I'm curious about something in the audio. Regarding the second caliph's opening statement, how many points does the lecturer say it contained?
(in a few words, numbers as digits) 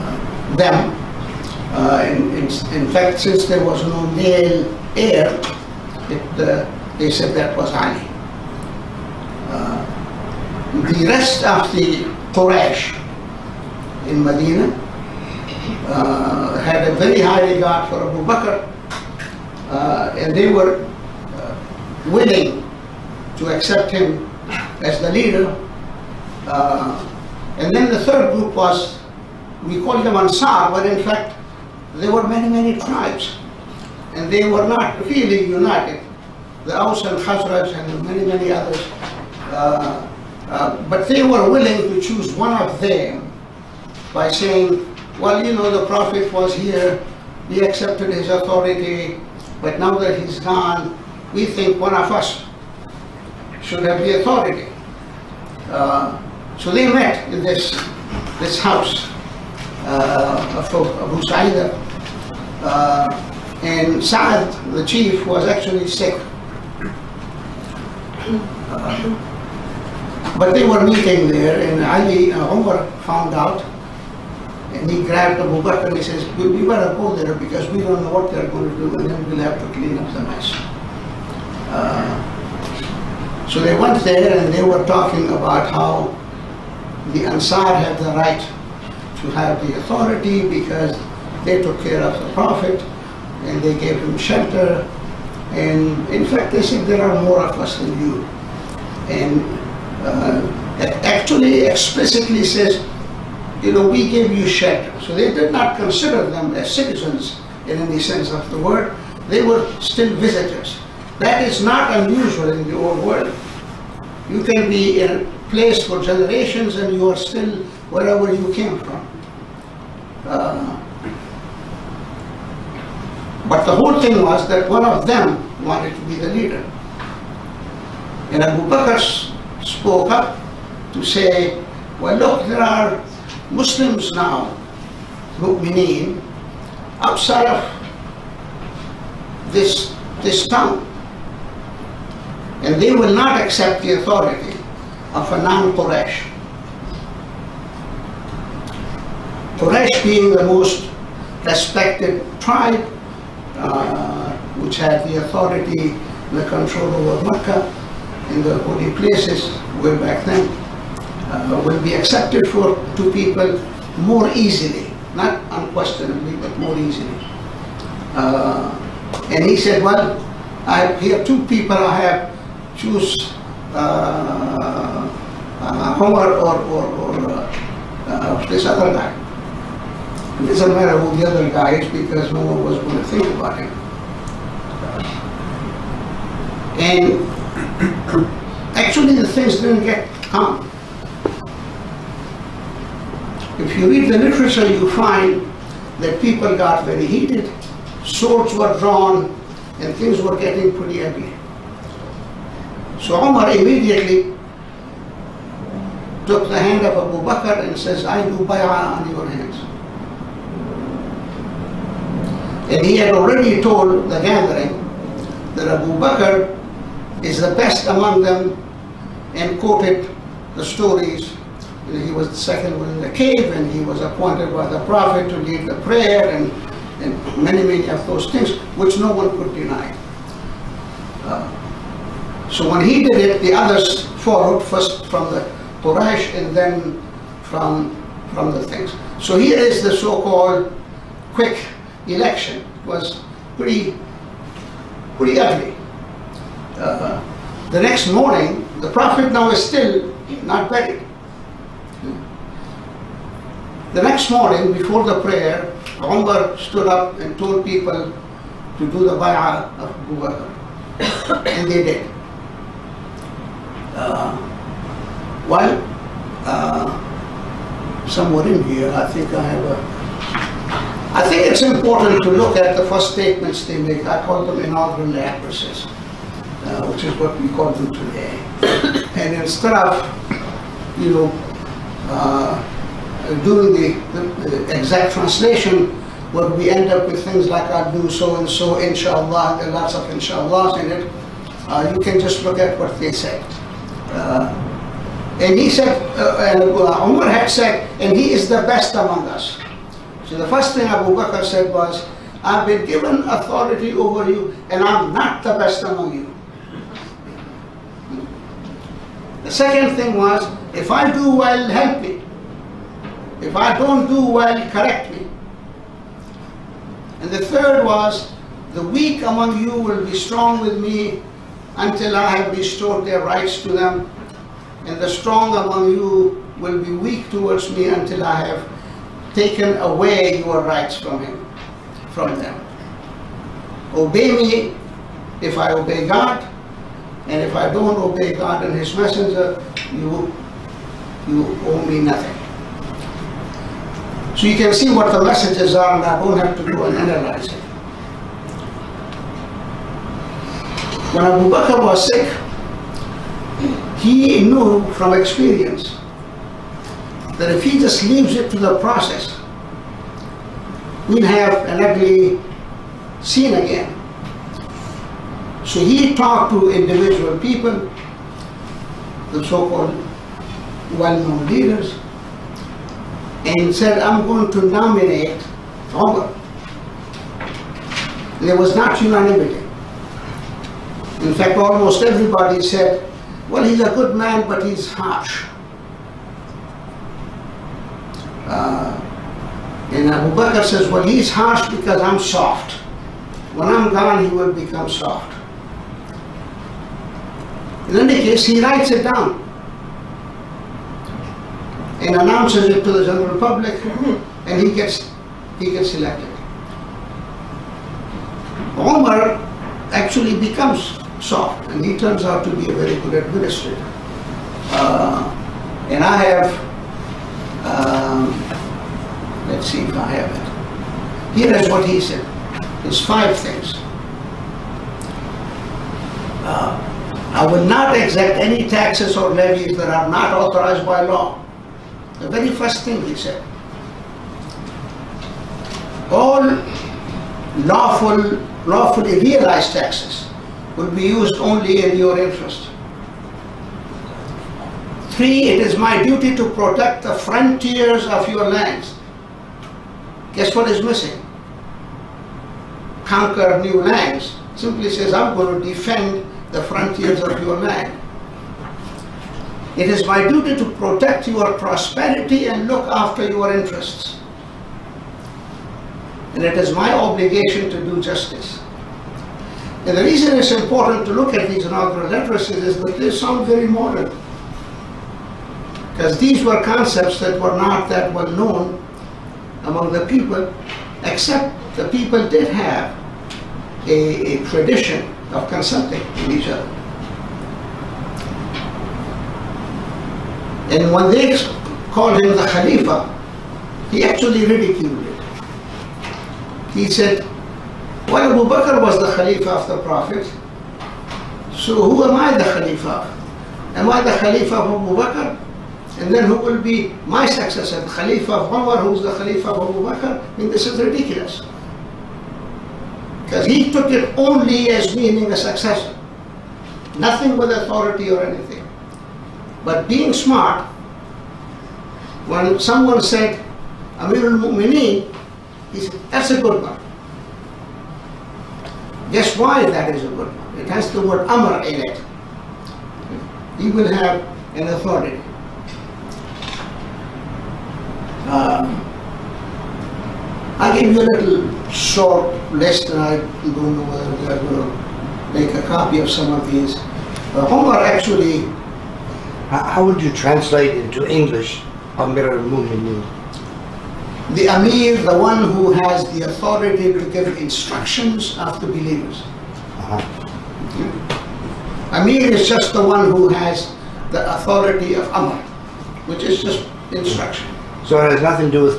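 5.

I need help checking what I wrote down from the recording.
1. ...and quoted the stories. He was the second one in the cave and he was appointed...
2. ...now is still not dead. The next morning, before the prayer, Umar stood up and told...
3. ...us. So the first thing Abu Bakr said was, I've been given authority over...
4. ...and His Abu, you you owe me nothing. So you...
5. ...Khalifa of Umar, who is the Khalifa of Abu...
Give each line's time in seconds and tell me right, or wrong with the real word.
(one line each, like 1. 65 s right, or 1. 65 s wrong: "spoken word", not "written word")
1. 219 s right
2. 249 s right
3. 299 s right
4. 338 s wrong: "Messenger", not "Abu"
5. 507 s right.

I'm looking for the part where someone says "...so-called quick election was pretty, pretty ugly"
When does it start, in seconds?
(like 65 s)
239 s.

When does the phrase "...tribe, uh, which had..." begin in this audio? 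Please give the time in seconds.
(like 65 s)
152 s.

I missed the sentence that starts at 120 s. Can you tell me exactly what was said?
Uh, but the whole thing was that one of them wanted to be the leader.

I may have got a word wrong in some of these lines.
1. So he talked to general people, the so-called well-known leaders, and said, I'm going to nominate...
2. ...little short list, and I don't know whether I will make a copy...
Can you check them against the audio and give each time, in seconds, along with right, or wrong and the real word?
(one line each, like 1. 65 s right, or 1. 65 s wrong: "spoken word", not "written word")
1. 365 s wrong: "individual", not "general"
2. 541 s right.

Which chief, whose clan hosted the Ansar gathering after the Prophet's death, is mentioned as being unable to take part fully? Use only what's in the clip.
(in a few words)
Saad.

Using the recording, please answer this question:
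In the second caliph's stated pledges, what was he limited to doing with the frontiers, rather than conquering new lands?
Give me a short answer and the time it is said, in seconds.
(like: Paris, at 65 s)
protect the frontiers, at 446 s.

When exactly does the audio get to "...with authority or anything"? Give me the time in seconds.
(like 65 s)
517 s.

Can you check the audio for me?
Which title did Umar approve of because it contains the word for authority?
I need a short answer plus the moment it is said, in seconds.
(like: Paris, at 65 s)
Amirul Mu'mineen, at 523 s.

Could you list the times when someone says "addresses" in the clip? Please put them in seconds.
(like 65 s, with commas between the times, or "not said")
275 s, 472 s.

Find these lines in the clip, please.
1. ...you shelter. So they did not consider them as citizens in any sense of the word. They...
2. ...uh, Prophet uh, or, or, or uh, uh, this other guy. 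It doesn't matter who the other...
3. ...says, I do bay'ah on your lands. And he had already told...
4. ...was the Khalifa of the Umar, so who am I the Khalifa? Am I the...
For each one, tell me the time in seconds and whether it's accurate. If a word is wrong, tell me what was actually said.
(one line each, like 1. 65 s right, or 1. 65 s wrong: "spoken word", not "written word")
1. 104 s right
2. 173 s wrong: "Omar", not "Prophet"
3. 207 s wrong: "hands", not "lands"
4. 498 s wrong: "Prophet", not "Umar".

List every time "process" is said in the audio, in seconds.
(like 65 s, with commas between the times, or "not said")
358 s.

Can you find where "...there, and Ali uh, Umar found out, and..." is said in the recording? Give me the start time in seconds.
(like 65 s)
71 s.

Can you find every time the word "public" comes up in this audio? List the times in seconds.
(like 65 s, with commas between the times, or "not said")
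403 s.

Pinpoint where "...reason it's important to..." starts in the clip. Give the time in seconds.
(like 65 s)
470 s.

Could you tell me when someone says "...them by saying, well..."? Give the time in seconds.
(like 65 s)
42 s.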